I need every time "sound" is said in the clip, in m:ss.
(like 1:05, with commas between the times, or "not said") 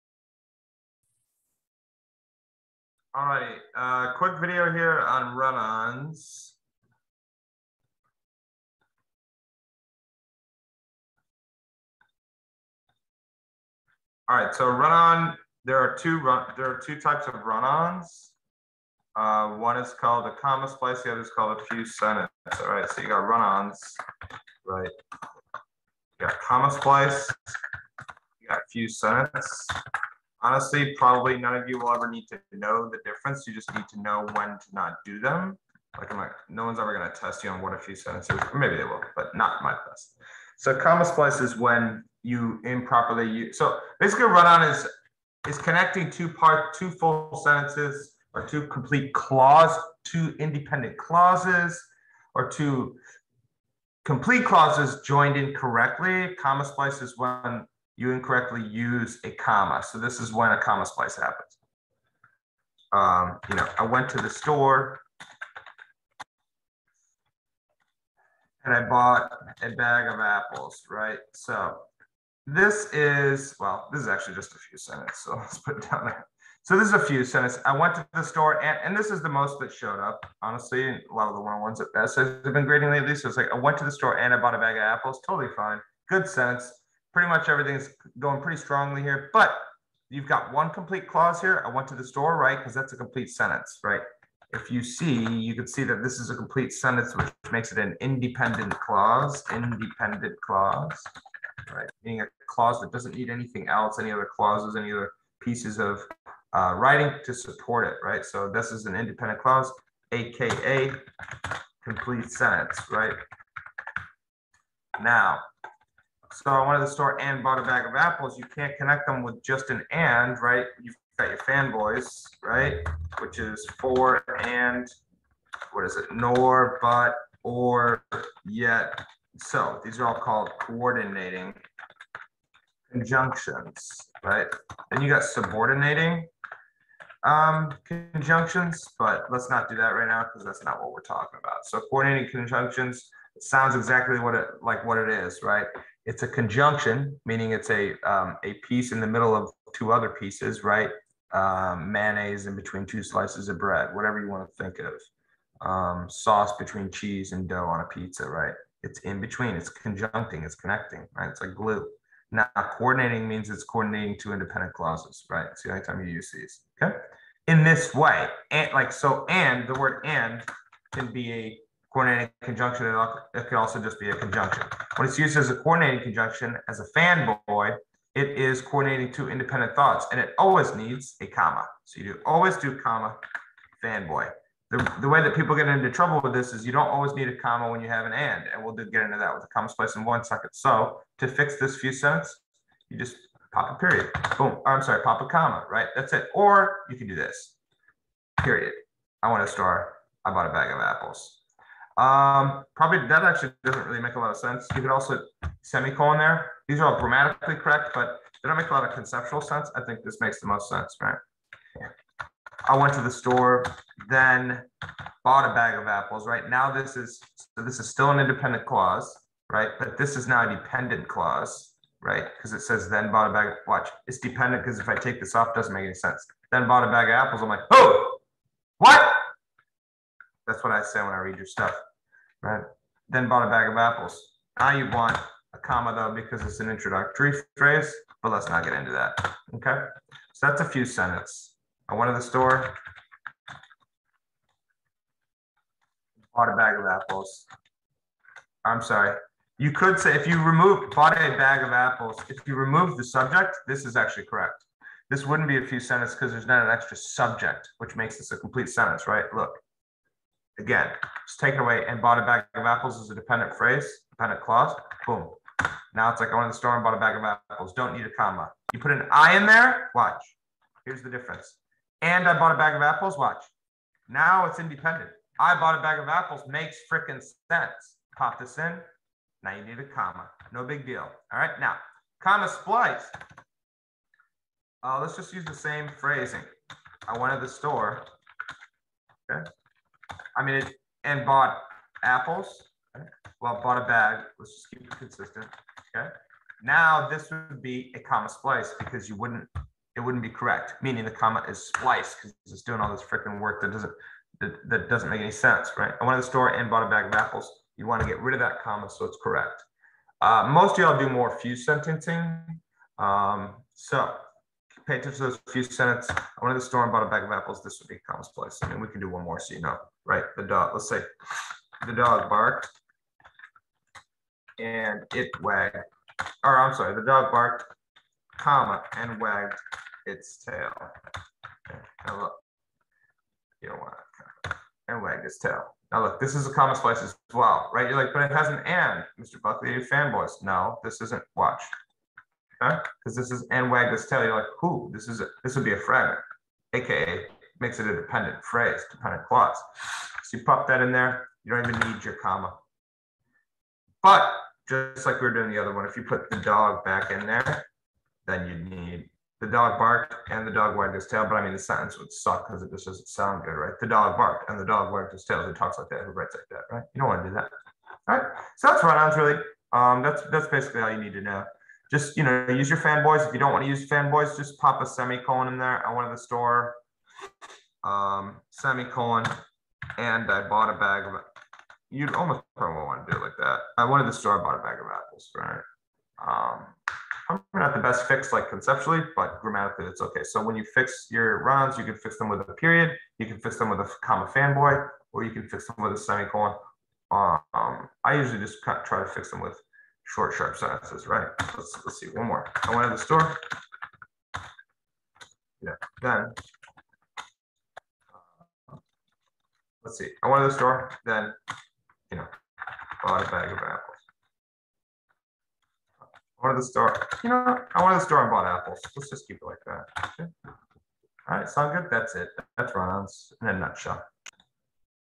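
2:23, 6:03, 7:01.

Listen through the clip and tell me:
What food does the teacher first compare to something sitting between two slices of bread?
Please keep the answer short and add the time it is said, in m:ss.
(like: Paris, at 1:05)
Mayonnaise, at 2:31.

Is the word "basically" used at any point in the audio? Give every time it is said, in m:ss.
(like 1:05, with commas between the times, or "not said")
0:43, 6:10.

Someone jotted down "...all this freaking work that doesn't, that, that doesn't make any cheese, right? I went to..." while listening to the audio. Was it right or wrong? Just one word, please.
wrong.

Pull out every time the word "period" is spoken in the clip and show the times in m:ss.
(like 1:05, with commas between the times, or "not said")
3:13, 3:18, 6:32.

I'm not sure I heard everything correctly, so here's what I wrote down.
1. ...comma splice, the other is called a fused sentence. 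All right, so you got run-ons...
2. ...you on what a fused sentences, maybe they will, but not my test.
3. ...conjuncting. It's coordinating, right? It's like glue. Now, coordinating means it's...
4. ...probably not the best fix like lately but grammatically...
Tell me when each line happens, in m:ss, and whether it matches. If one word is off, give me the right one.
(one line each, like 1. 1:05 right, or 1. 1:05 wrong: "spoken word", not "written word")
1. 0:20 right
2. 0:37 right
3. 2:39 wrong: "connecting", not "coordinating"
4. 6:27 wrong: "conceptually", not "lately".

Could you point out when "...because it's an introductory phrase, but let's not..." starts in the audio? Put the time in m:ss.
3:56.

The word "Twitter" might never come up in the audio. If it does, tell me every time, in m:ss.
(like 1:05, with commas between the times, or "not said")
not said.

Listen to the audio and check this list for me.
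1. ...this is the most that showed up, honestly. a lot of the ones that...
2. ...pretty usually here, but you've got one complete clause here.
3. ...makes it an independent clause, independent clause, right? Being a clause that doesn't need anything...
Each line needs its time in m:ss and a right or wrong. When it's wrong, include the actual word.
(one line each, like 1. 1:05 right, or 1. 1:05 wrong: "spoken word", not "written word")
1. 1:18 right
2. 1:28 wrong: "strongly", not "usually"
3. 1:37 right.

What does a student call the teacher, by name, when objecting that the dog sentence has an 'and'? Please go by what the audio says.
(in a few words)
Mr. Buckley.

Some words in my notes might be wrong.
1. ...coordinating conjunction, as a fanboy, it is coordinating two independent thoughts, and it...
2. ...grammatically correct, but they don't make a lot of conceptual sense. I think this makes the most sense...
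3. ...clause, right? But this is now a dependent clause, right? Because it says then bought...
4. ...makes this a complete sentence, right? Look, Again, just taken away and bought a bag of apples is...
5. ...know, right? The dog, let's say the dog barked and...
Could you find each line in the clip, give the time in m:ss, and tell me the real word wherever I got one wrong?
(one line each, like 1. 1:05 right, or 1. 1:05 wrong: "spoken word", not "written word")
1. 2:55 right
2. 3:26 right
3. 3:38 right
4. 4:17 right
5. 5:19 right.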